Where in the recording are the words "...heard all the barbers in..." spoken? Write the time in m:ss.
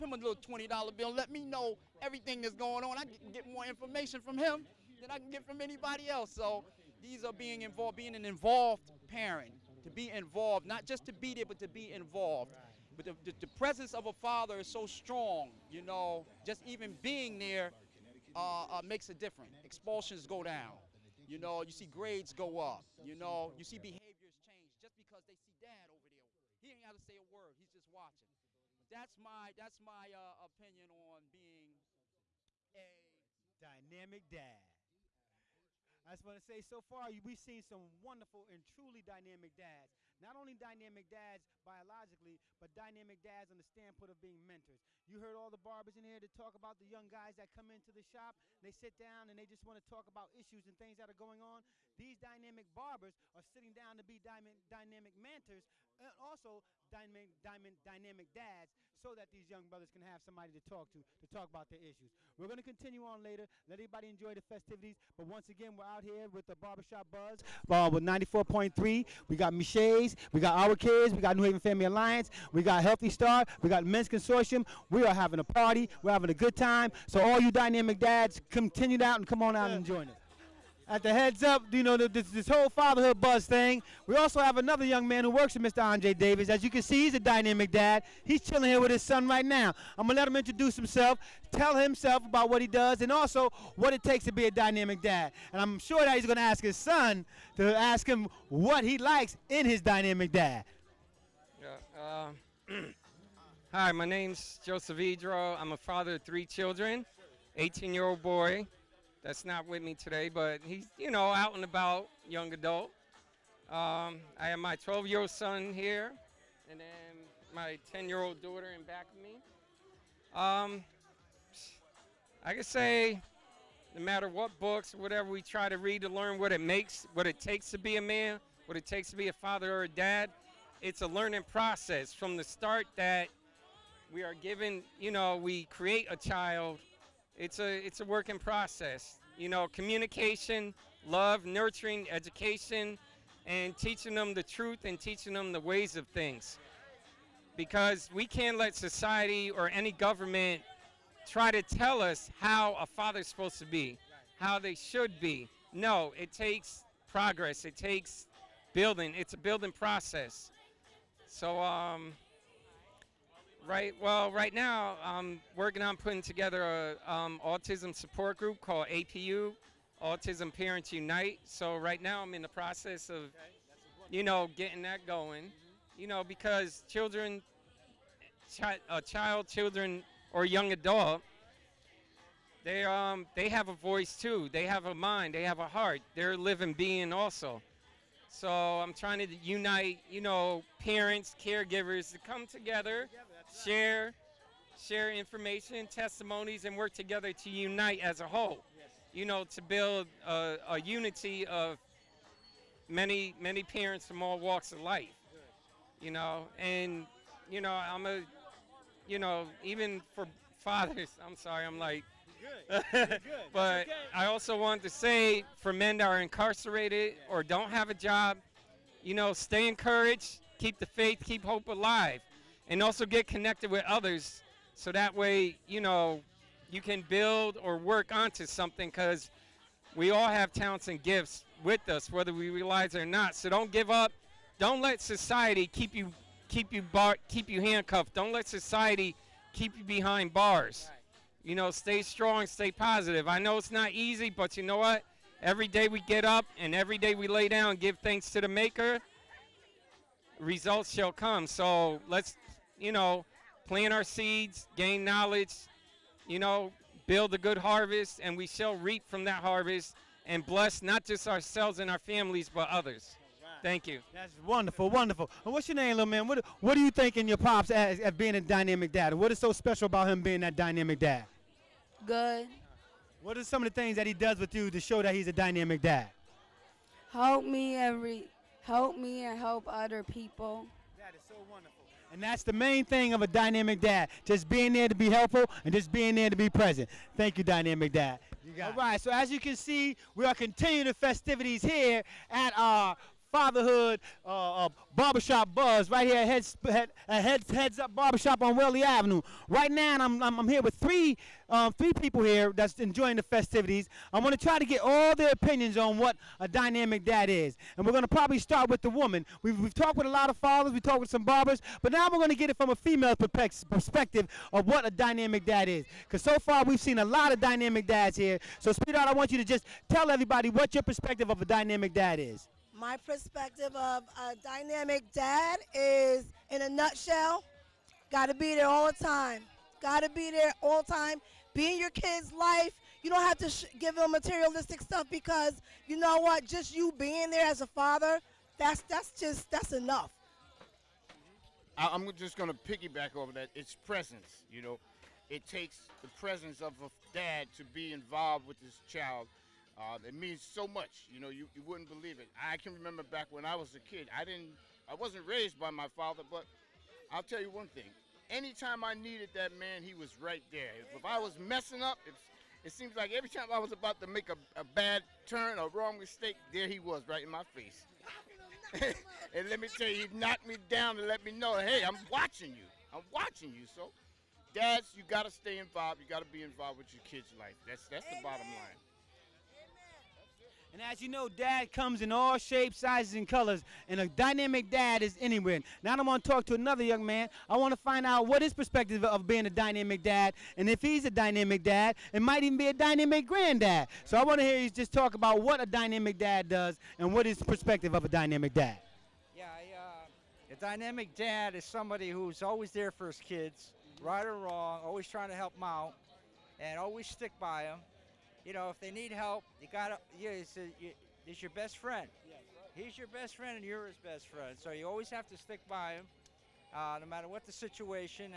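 0:45.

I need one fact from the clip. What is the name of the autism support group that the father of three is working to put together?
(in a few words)
Autism Parents Unite.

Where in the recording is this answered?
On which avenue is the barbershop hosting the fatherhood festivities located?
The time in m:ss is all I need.
4:58.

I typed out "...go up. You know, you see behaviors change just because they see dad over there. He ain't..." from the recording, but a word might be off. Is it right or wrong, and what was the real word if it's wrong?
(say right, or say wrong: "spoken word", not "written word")
right.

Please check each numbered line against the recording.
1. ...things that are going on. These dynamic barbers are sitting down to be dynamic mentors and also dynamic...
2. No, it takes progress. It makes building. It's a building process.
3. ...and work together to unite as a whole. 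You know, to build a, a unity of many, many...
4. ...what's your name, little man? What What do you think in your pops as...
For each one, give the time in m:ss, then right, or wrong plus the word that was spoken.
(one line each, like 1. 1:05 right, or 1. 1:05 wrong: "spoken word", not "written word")
1. 0:50 right
2. 2:35 wrong: "takes", not "makes"
3. 3:16 right
4. 4:25 right.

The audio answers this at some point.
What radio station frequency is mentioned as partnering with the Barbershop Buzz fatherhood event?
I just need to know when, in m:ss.
1:08.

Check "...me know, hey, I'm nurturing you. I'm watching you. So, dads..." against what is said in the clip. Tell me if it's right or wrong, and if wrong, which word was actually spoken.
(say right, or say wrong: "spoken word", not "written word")
wrong: "watching", not "nurturing".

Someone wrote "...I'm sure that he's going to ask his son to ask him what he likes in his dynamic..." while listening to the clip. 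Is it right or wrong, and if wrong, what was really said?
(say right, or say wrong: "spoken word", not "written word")
right.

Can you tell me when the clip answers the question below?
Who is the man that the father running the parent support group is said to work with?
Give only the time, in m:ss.
1:25.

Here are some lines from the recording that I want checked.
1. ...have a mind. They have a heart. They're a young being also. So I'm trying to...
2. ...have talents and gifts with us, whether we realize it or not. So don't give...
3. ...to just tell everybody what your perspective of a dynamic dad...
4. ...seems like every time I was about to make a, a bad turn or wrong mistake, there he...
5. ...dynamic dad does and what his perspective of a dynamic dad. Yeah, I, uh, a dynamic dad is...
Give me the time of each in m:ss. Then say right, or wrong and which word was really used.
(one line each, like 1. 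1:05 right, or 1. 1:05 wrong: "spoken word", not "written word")
1. 3:04 wrong: "living", not "young"
2. 3:50 right
3. 5:19 right
4. 6:02 right
5. 6:35 right.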